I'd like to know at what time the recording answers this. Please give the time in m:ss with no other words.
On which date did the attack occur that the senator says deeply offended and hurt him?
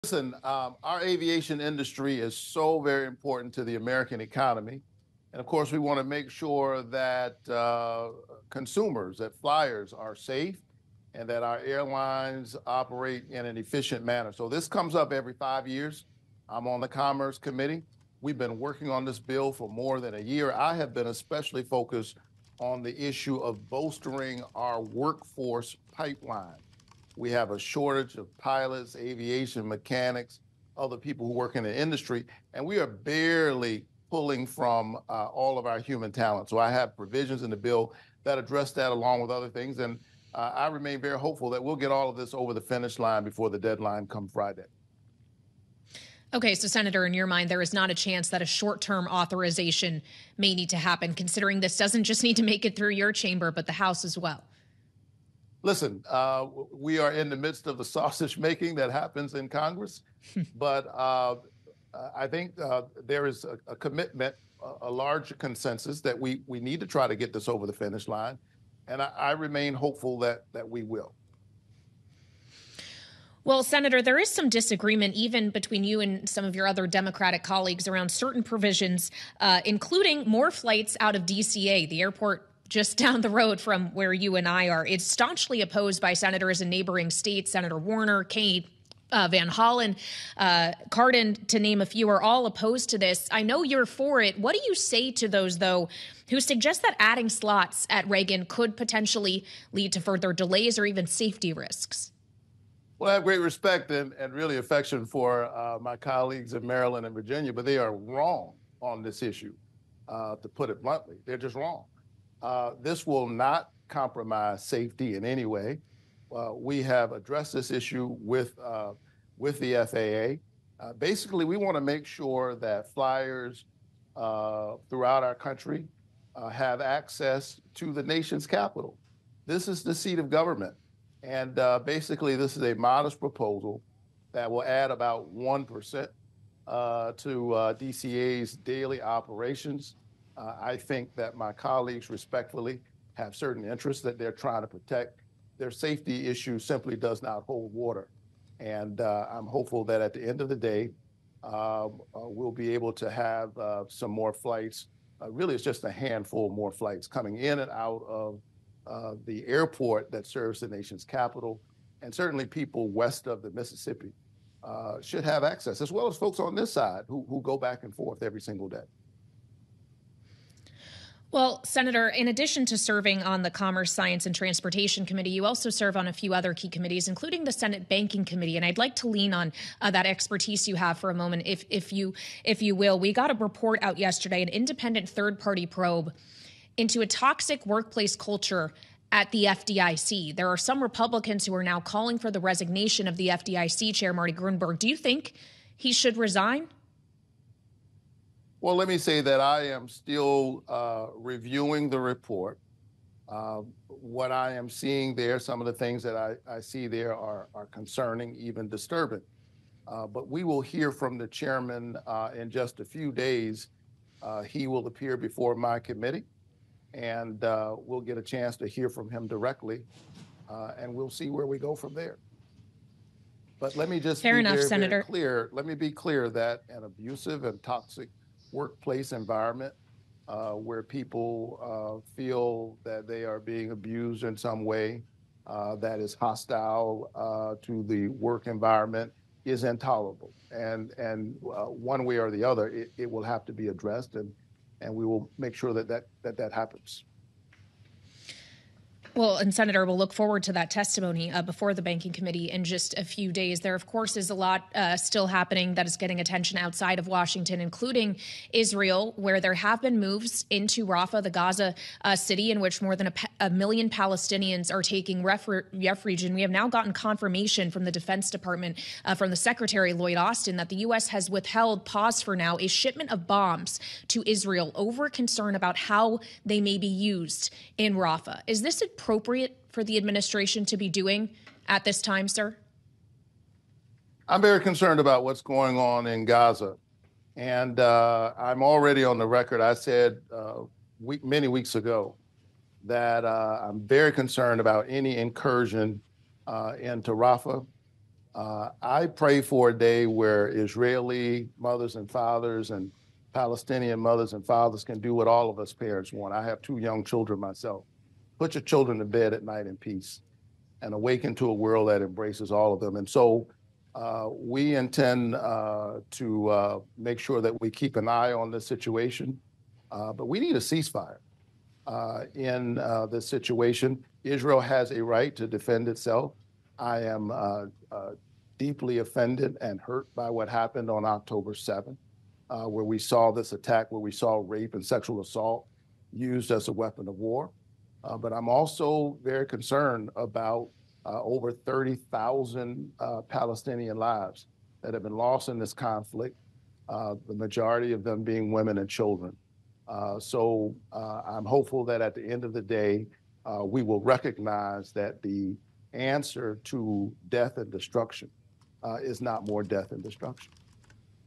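5:31.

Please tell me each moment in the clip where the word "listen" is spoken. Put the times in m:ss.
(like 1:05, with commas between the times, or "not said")
0:00, 0:55.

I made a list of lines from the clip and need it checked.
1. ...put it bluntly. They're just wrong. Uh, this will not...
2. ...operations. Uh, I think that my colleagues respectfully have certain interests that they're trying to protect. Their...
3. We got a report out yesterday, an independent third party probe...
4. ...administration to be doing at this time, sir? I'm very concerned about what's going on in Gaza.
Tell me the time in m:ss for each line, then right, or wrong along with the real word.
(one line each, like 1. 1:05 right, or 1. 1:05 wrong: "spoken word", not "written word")
1. 1:50 right
2. 2:19 right
3. 3:02 right
4. 4:39 right.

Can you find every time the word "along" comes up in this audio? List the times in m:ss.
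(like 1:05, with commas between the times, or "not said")
0:38.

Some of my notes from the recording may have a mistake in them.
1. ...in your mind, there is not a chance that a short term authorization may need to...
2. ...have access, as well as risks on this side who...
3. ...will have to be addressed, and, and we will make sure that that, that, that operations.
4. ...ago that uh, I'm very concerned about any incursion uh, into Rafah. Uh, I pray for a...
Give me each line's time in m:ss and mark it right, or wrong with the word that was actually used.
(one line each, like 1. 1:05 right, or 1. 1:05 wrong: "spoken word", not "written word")
1. 0:47 right
2. 2:45 wrong: "folks", not "risks"
3. 4:03 wrong: "happens", not "operations"
4. 4:51 right.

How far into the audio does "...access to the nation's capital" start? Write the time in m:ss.
2:06.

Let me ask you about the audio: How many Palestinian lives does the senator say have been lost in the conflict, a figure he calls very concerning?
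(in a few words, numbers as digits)
over 30,000.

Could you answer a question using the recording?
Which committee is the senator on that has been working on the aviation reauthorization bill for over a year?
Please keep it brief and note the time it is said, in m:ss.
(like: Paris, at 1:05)
Commerce Committee, at 0:16.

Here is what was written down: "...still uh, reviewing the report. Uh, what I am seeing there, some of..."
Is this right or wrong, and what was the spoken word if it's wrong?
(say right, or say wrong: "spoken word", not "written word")
right.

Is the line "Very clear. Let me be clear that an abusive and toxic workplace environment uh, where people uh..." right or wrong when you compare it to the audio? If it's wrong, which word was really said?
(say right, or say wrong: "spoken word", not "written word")
right.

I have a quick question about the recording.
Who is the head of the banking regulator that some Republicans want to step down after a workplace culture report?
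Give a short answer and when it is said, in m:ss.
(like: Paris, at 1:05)
Marty Gruenberg, at 3:14.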